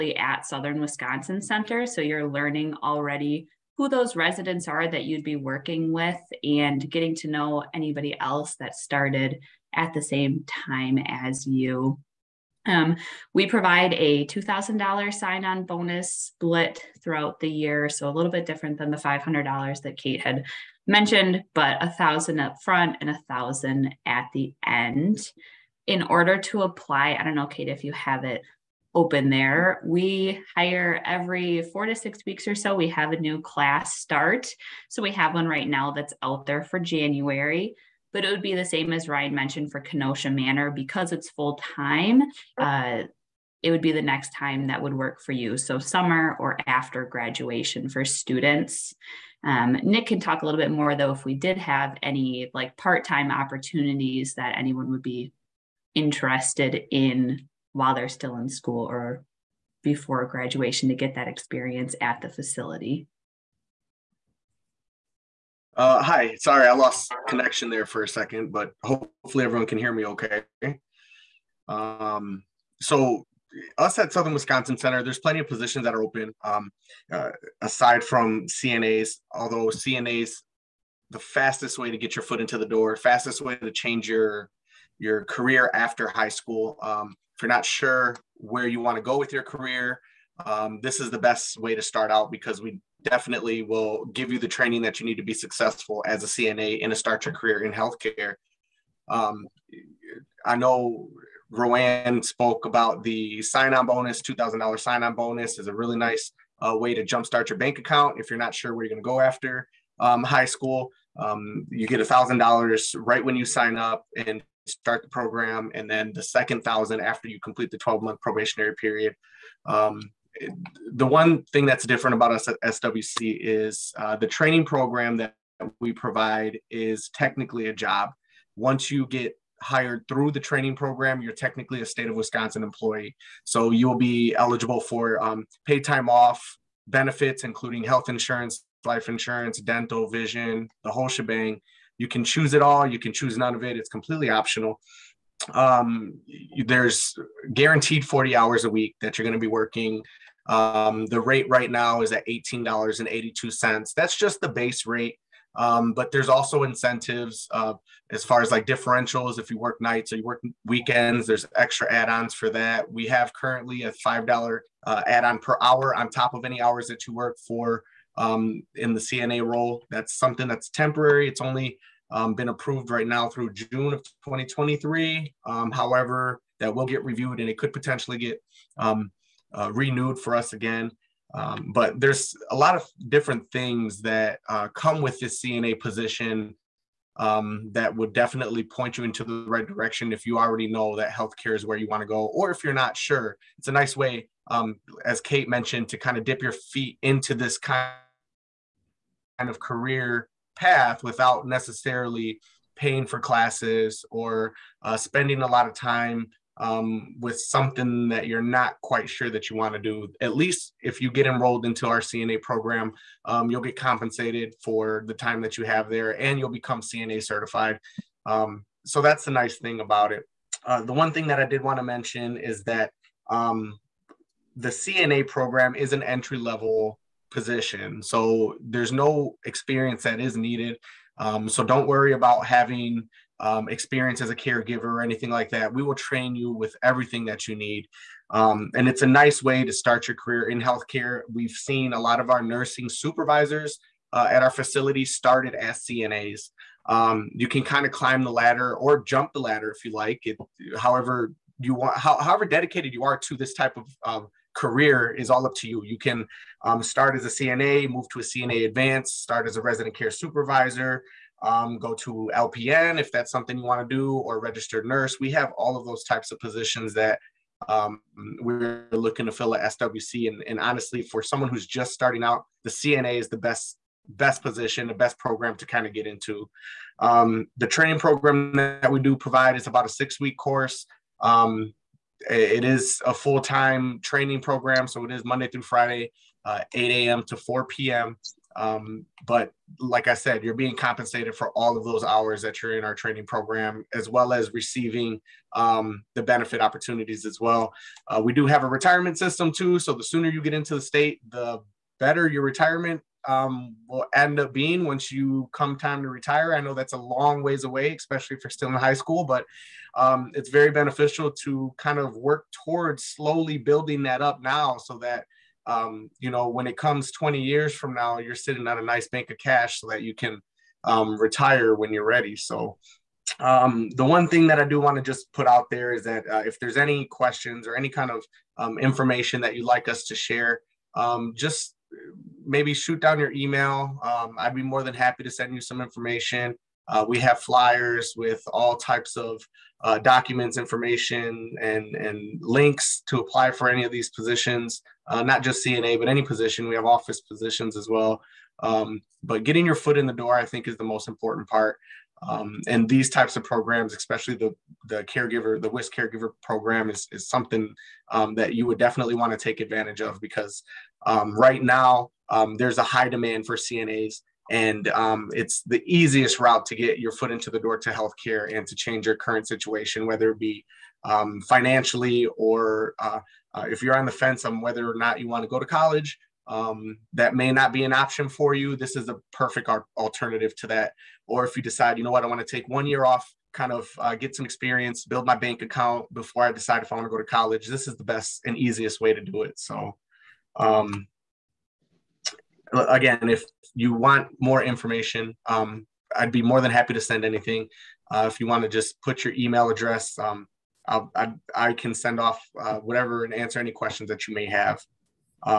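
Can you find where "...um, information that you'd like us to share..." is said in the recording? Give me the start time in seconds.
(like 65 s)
328 s.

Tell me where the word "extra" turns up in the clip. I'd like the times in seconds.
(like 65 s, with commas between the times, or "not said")
161 s.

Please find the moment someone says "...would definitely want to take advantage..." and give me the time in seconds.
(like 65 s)
358 s.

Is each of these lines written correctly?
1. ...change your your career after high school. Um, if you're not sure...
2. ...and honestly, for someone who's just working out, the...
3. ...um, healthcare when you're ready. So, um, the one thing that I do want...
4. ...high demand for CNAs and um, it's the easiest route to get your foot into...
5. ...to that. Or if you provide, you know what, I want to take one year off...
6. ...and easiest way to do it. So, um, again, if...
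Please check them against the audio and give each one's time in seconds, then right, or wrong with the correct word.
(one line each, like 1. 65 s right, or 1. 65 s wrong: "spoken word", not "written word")
1. 83 s right
2. 270 s wrong: "starting", not "working"
3. 320 s wrong: "retire", not "healthcare"
4. 362 s right
5. 380 s wrong: "decide", not "provide"
6. 388 s right.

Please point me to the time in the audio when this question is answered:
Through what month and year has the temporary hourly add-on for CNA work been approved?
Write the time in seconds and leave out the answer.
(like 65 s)
173 s.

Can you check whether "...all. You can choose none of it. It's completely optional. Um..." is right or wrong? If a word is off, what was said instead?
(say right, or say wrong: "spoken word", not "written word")
right.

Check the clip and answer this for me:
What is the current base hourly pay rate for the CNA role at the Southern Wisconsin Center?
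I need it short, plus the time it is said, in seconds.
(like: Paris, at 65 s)
$18.82, at 152 s.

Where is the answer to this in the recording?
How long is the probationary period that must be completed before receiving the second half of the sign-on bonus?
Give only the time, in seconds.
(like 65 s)
117 s.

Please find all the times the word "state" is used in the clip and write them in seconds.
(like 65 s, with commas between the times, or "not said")
131 s, 300 s.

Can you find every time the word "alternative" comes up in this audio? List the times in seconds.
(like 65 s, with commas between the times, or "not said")
379 s.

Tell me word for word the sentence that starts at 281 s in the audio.
Um, it is a full time training program, so it is Monday through Friday, uh, 8 a.m.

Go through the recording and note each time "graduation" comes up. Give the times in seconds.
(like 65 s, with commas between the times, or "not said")
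47 s, 60 s.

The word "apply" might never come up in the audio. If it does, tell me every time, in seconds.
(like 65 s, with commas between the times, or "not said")
26 s, 343 s.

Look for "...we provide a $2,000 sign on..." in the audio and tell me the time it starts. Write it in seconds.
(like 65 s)
13 s.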